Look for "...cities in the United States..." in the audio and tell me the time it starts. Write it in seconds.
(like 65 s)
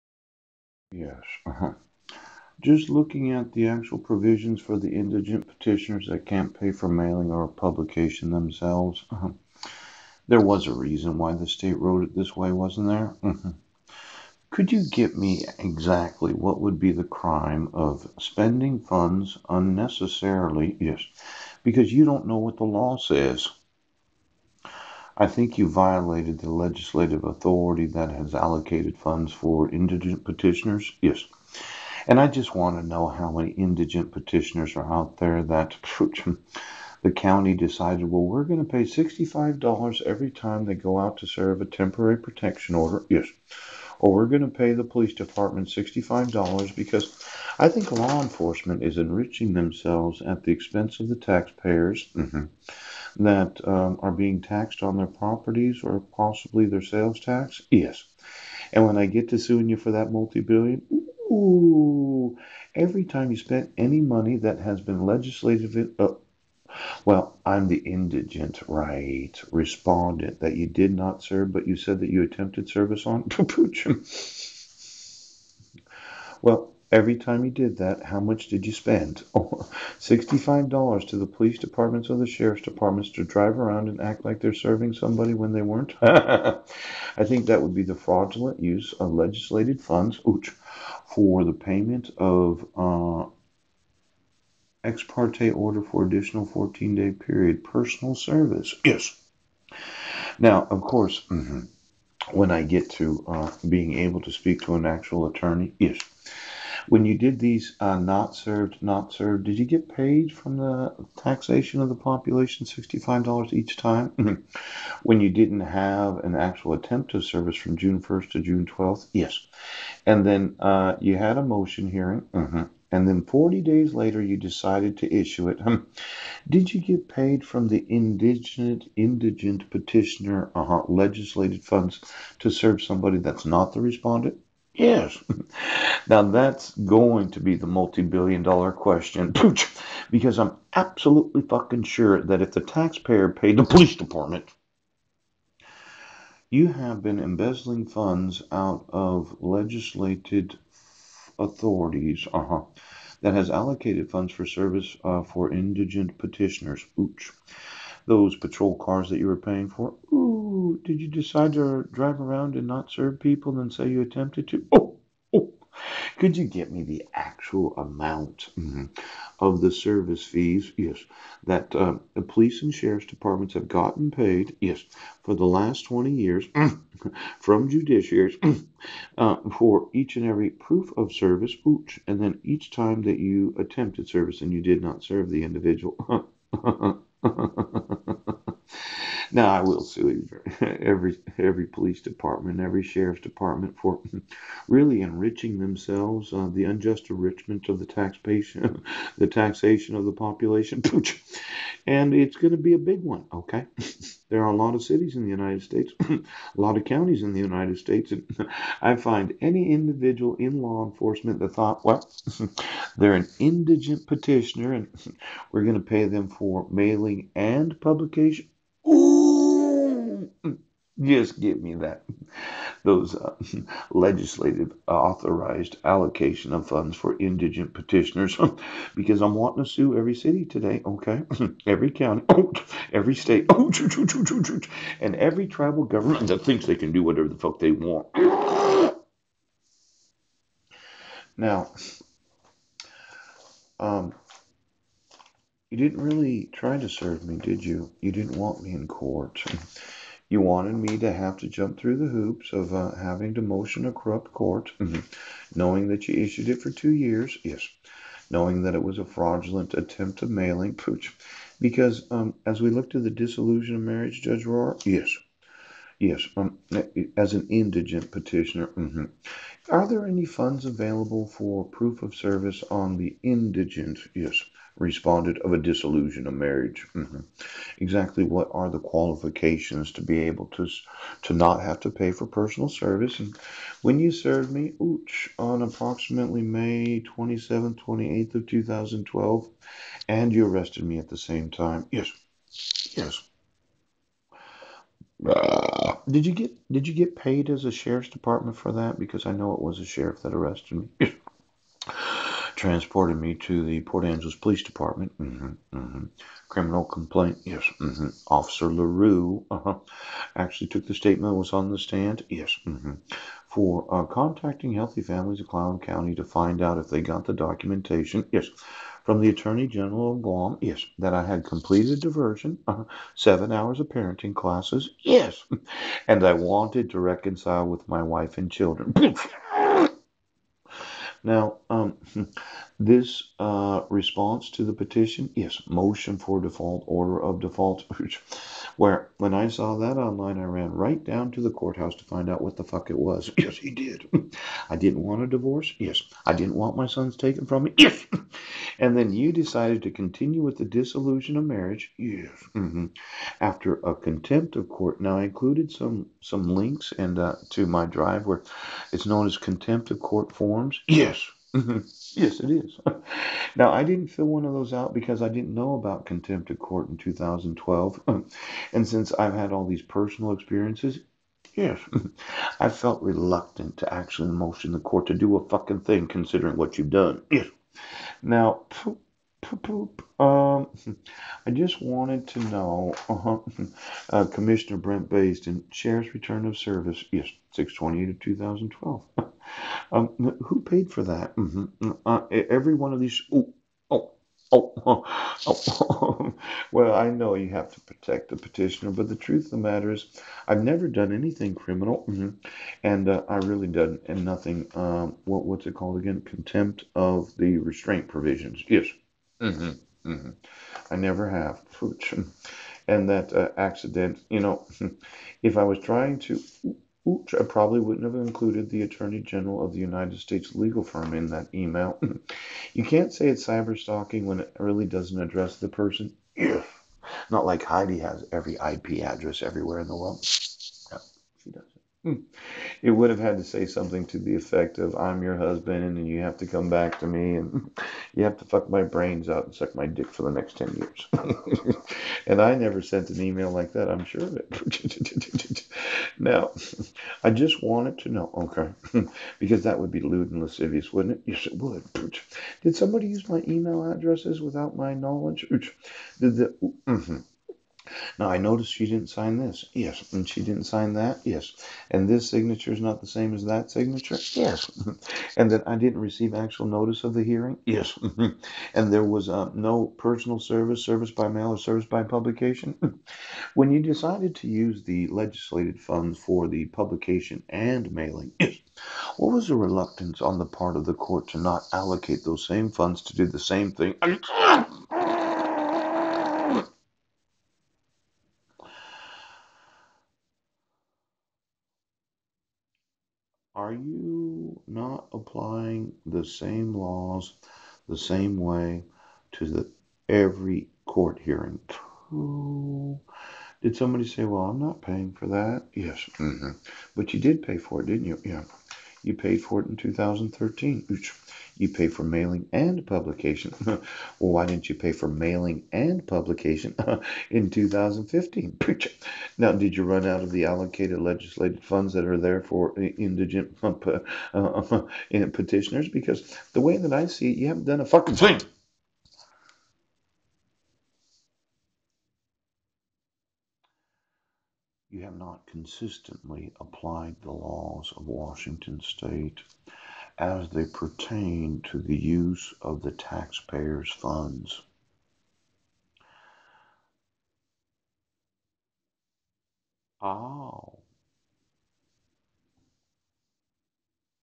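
204 s.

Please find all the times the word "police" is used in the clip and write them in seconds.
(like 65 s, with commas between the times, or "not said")
44 s, 81 s, 143 s, 172 s, 191 s, 304 s.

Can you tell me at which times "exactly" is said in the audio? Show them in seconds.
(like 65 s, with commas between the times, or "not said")
15 s, 277 s.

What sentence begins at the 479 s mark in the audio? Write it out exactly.
What was the reluctance on the part of the court to not allocate those same funds to do the same thing?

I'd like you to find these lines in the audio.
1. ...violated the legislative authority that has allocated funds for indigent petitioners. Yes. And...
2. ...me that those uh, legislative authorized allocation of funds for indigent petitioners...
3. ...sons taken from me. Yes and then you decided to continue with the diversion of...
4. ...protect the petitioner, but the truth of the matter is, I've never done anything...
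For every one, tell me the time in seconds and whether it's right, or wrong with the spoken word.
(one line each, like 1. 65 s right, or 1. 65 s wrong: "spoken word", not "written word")
1. 25 s right
2. 221 s right
3. 346 s wrong: "dissolution", not "diversion"
4. 397 s right.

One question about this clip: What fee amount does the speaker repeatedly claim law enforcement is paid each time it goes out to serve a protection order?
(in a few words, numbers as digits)
$65.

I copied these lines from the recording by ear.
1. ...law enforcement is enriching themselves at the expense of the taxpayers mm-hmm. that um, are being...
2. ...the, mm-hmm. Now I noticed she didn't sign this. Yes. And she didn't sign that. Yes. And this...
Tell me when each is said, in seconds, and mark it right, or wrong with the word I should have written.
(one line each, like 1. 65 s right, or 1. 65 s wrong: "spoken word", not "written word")
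1. 47 s right
2. 456 s right.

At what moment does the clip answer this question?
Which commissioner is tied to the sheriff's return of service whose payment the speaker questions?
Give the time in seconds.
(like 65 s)
384 s.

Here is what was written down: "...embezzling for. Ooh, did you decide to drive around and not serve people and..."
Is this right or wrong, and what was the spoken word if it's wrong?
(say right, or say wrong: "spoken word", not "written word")
wrong: "paying", not "embezzling".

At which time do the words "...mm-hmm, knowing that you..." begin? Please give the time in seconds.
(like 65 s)
254 s.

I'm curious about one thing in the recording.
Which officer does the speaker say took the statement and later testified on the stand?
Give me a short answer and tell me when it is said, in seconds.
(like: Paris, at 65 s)
Officer LaRue, at 308 s.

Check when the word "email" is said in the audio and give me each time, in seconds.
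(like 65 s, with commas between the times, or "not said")
421 s, 443 s, 453 s.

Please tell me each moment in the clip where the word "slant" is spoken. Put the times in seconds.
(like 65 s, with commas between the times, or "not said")
not said.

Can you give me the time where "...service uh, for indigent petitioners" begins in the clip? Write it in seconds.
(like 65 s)
154 s.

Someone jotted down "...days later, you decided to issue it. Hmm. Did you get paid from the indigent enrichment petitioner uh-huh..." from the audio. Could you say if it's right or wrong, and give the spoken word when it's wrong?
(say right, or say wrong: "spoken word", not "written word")
wrong: "indigent", not "enrichment".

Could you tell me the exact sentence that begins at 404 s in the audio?
Um, what what's it called again?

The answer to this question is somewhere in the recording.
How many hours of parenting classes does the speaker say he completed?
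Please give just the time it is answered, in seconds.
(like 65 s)
323 s.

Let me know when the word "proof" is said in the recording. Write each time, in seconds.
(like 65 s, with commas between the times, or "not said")
180 s, 271 s.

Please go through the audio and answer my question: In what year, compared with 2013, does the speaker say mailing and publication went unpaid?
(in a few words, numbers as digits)
2015.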